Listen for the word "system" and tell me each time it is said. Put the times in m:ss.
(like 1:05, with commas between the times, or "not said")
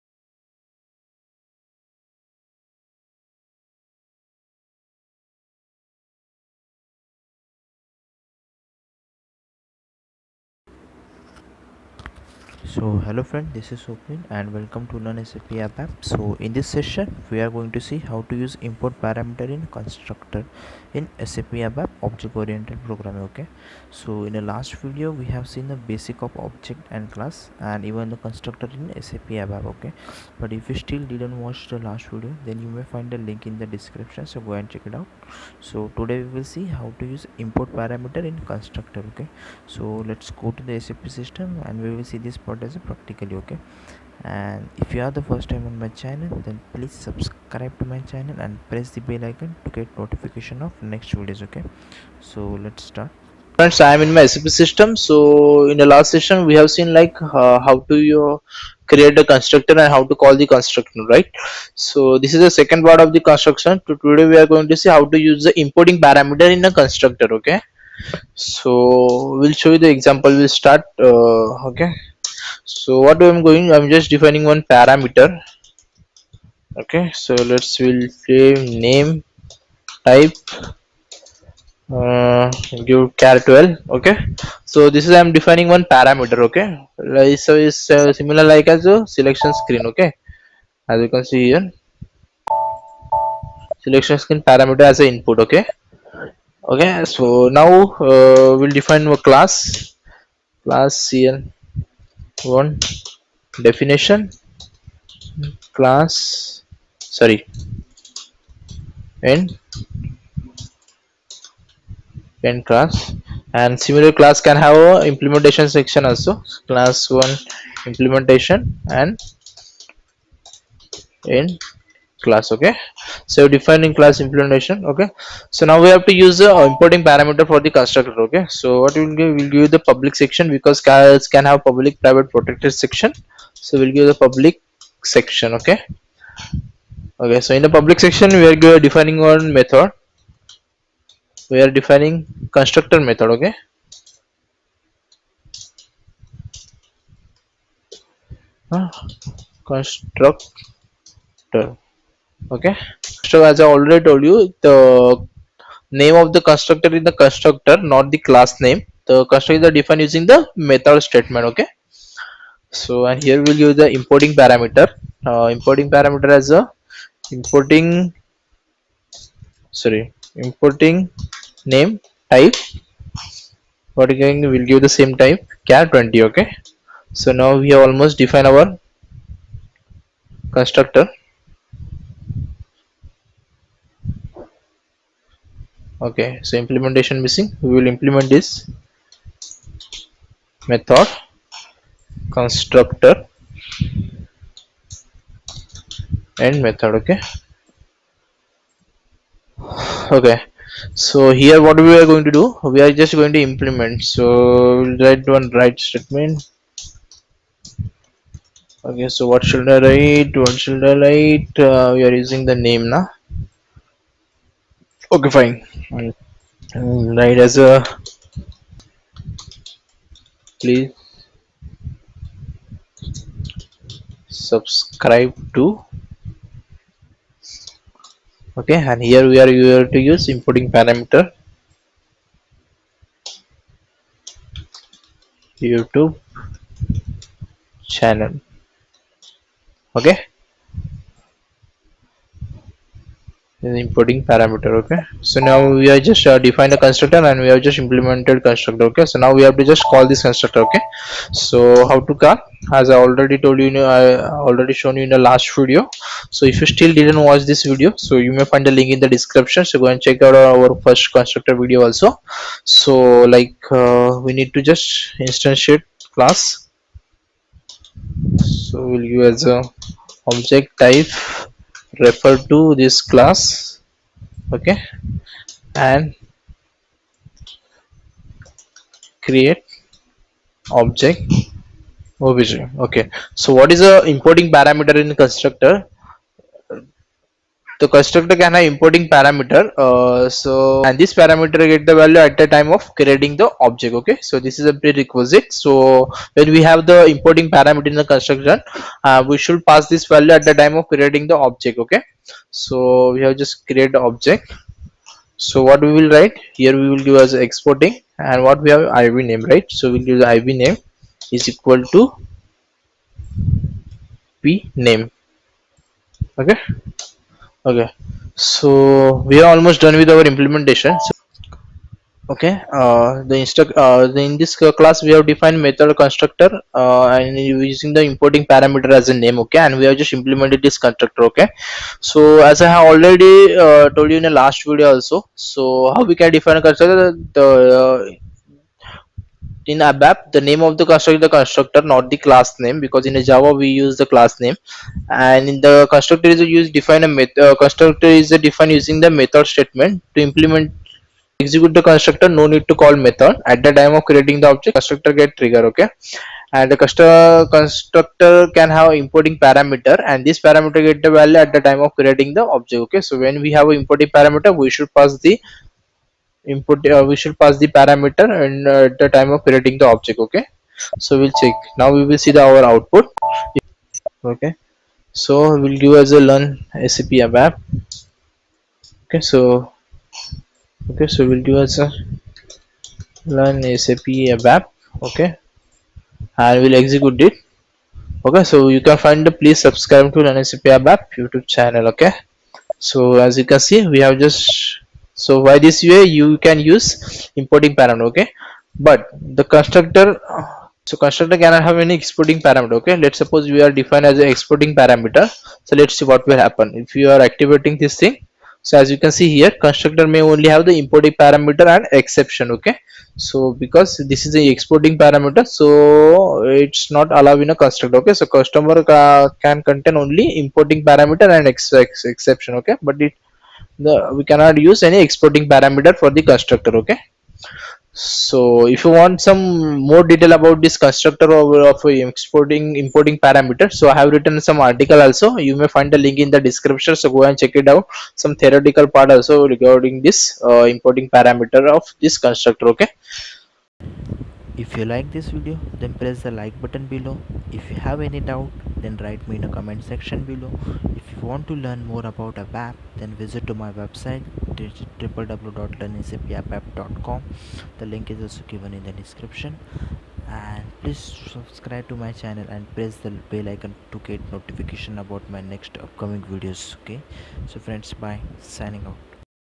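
0:41, 0:54.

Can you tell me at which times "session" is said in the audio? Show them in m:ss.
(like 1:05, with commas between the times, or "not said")
0:16, 0:56.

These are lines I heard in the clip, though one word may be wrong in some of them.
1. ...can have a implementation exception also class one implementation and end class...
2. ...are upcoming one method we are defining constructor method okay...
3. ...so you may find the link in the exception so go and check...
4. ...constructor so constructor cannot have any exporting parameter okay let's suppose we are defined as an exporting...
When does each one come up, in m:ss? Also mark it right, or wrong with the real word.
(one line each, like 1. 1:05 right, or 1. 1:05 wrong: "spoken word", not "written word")
1. 1:54 wrong: "section", not "exception"
2. 2:18 wrong: "defining", not "upcoming"
3. 4:17 wrong: "description", not "exception"
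4. 6:39 right.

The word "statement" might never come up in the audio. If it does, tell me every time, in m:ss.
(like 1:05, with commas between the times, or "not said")
2:41, 3:25, 5:49.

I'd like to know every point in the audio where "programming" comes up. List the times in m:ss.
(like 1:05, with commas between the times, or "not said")
0:22.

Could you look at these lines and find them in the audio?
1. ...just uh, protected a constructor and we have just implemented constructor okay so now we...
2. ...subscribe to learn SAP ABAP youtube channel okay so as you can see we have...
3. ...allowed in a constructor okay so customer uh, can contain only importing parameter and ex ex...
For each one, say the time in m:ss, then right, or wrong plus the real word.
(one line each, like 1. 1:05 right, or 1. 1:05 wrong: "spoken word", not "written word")
1. 4:05 wrong: "defined", not "protected"
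2. 6:29 right
3. 6:57 right.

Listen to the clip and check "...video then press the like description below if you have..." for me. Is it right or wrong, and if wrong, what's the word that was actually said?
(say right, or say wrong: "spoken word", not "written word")
wrong: "button", not "description".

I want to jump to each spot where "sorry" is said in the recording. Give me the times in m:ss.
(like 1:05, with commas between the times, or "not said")
1:46, 2:49.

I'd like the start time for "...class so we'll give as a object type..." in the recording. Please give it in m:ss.
4:26.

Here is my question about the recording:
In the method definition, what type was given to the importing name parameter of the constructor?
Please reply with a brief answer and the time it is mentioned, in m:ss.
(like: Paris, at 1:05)
car 20, at 2:55.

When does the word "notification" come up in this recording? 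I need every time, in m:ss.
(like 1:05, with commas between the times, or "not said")
0:49, 7:44.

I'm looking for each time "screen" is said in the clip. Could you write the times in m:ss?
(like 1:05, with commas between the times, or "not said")
1:29, 1:34.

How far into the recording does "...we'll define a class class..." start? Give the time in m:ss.
1:38.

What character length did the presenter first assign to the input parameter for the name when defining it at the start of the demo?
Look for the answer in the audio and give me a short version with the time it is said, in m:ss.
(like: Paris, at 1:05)
char 12, at 1:23.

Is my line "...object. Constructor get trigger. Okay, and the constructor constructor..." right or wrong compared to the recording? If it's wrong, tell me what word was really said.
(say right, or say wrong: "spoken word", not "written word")
right.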